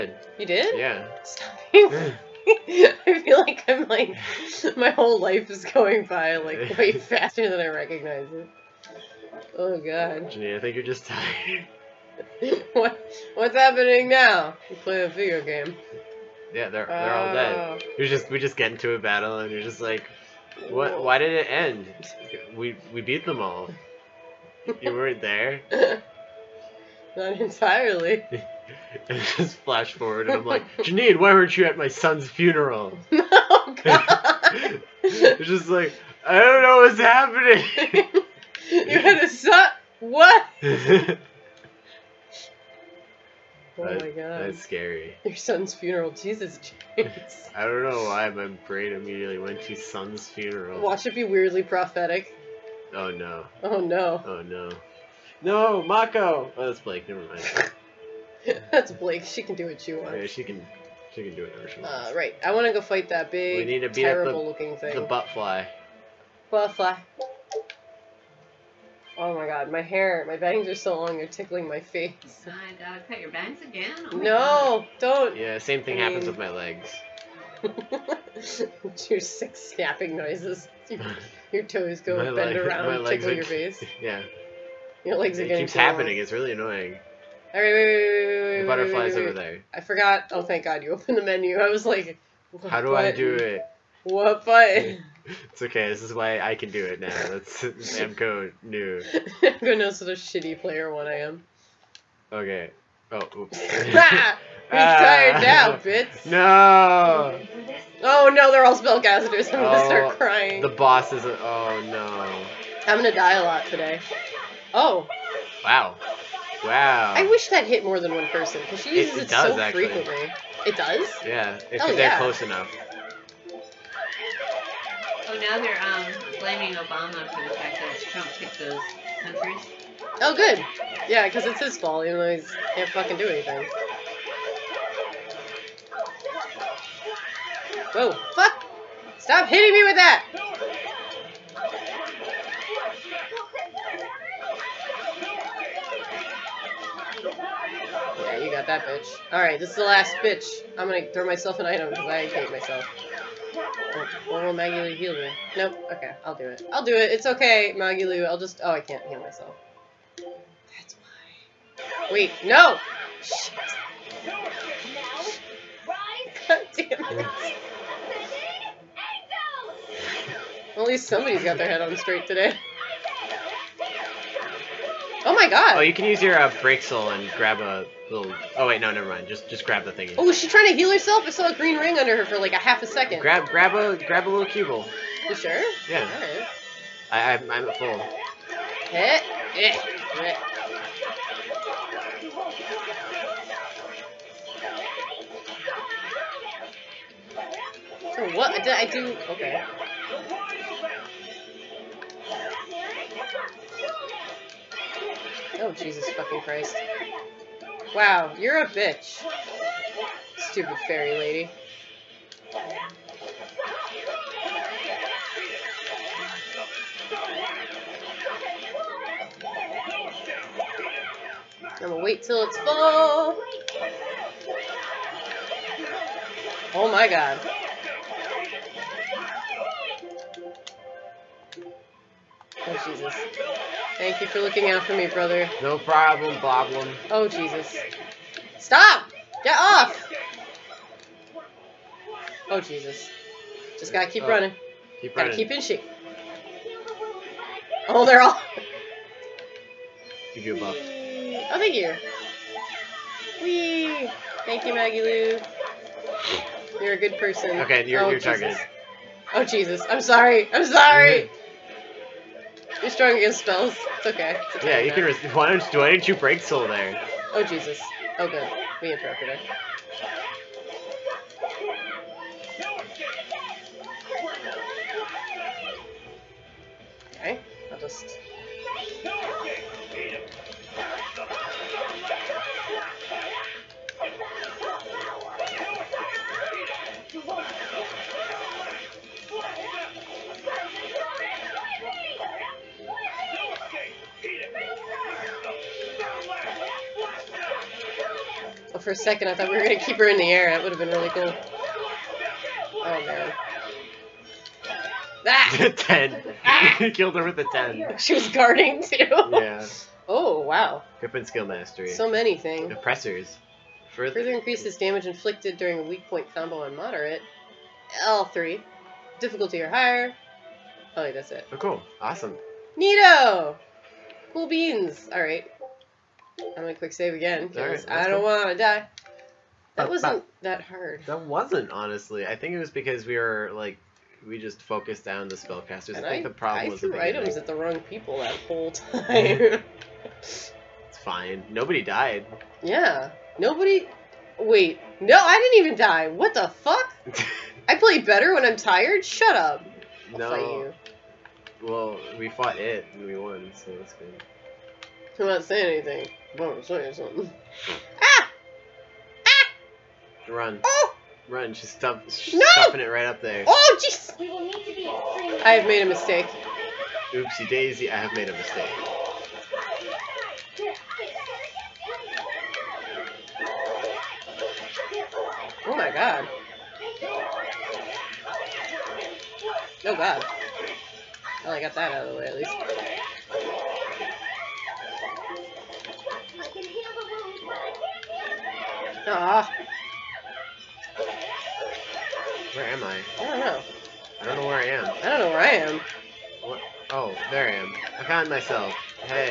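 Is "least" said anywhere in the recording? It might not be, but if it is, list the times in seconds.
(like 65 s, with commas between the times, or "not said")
170 s, 382 s.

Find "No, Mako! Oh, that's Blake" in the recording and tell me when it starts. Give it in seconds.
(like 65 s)
55 s.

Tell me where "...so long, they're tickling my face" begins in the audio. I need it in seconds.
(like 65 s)
70 s.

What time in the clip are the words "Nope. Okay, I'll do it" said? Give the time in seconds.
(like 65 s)
155 s.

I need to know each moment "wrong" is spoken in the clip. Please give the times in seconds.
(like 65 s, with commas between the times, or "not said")
337 s.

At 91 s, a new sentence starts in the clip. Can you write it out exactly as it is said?
I was like, how do button?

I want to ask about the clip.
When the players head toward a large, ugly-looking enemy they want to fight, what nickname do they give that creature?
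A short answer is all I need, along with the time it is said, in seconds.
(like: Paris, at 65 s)
Butt fly, at 64 s.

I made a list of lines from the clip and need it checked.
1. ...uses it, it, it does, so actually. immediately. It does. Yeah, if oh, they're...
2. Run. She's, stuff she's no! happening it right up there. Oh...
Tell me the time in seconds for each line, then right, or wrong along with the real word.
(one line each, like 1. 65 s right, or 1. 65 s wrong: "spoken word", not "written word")
1. 118 s wrong: "frequently", not "immediately"
2. 361 s wrong: "stuffing", not "happening".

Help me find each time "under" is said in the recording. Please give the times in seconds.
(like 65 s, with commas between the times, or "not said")
181 s.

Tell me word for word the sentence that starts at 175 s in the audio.
Oh, you can use your uh, brake and grab a little.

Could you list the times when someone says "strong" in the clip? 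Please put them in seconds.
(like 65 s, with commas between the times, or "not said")
262 s.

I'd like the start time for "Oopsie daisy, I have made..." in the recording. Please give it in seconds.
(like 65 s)
367 s.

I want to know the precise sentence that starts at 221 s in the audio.
I'm gonna wait till it's full.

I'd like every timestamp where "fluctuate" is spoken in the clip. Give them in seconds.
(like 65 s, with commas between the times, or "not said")
not said.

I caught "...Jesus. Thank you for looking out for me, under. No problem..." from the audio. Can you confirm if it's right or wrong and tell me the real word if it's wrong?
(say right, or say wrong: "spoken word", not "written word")
wrong: "brother", not "under".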